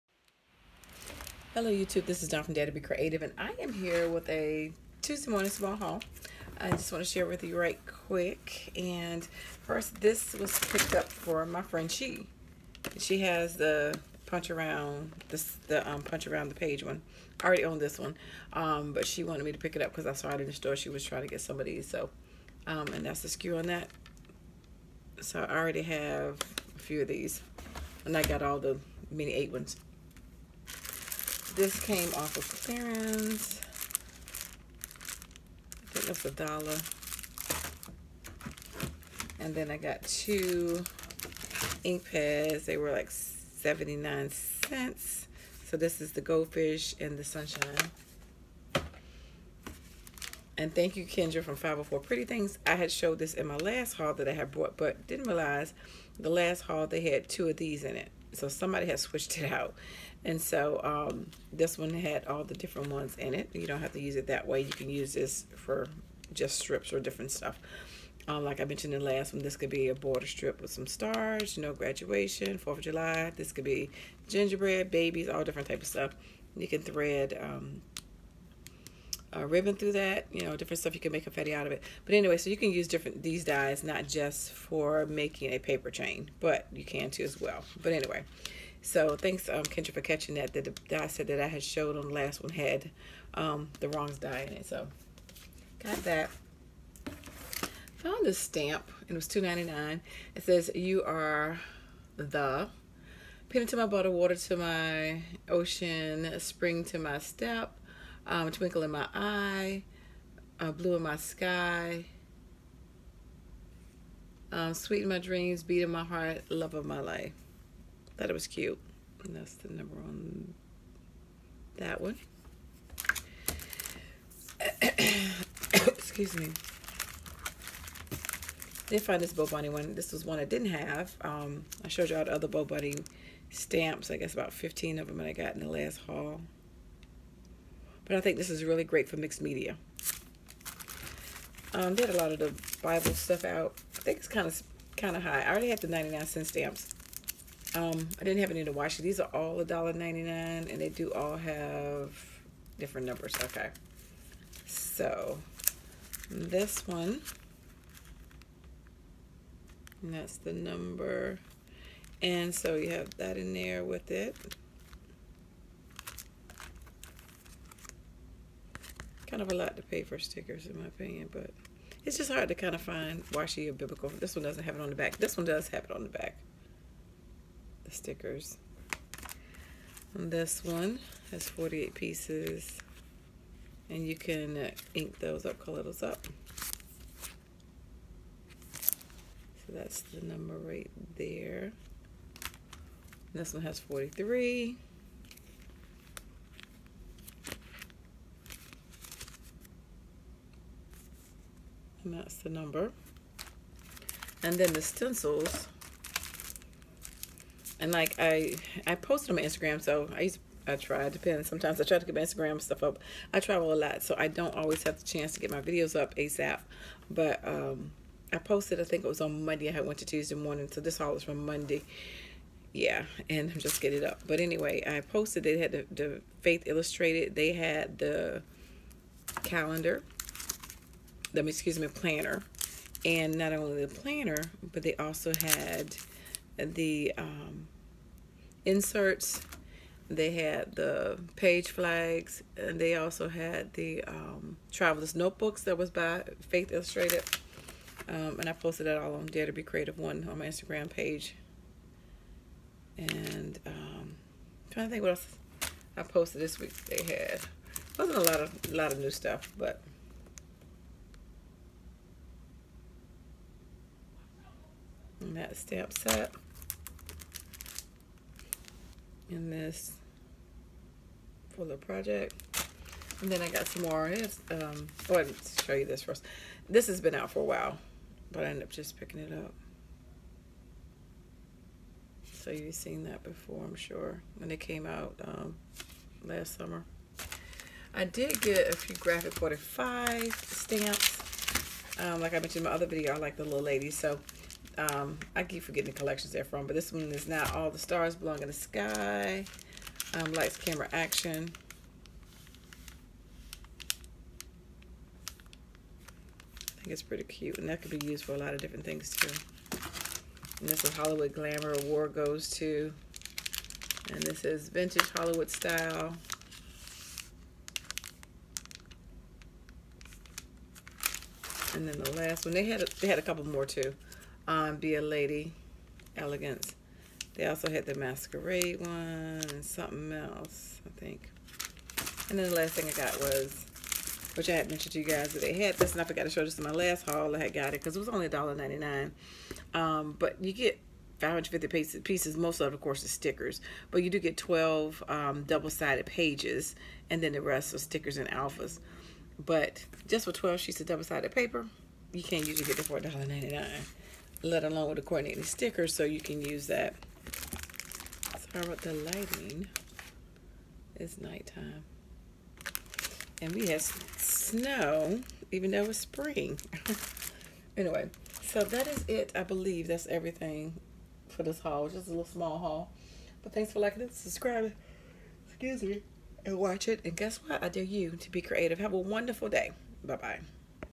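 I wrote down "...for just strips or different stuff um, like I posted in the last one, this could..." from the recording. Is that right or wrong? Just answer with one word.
wrong.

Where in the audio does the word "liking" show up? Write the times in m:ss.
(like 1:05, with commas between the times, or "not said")
6:13.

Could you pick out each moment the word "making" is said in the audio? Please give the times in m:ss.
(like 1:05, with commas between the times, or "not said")
1:25.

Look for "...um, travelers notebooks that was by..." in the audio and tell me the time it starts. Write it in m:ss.
4:04.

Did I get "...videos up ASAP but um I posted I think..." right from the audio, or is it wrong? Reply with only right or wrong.
right.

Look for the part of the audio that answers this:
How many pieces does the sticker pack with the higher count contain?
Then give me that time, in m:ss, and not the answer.
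3:01.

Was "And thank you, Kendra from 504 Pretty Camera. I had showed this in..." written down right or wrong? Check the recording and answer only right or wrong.
wrong.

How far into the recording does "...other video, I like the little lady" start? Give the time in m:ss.
4:52.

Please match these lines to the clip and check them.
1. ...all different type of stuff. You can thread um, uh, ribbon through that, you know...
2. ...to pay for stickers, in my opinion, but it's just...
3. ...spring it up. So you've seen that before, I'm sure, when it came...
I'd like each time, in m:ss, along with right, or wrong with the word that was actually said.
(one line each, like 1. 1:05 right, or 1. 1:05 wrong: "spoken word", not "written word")
1. 1:15 right
2. 2:49 right
3. 4:38 wrong: "picking", not "spring".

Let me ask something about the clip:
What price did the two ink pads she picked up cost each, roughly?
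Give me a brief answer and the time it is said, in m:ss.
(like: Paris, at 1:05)
79 cents, at 0:43.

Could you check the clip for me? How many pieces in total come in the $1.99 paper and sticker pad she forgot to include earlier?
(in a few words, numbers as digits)
550.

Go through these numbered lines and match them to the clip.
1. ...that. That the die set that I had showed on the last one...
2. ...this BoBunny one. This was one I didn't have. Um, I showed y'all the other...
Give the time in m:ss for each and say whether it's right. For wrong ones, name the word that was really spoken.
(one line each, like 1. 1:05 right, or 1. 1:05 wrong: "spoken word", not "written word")
1. 1:30 right
2. 2:09 right.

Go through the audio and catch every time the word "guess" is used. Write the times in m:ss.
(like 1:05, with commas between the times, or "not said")
2:14, 6:17.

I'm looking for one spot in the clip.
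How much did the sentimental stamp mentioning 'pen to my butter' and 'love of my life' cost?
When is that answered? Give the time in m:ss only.
1:39.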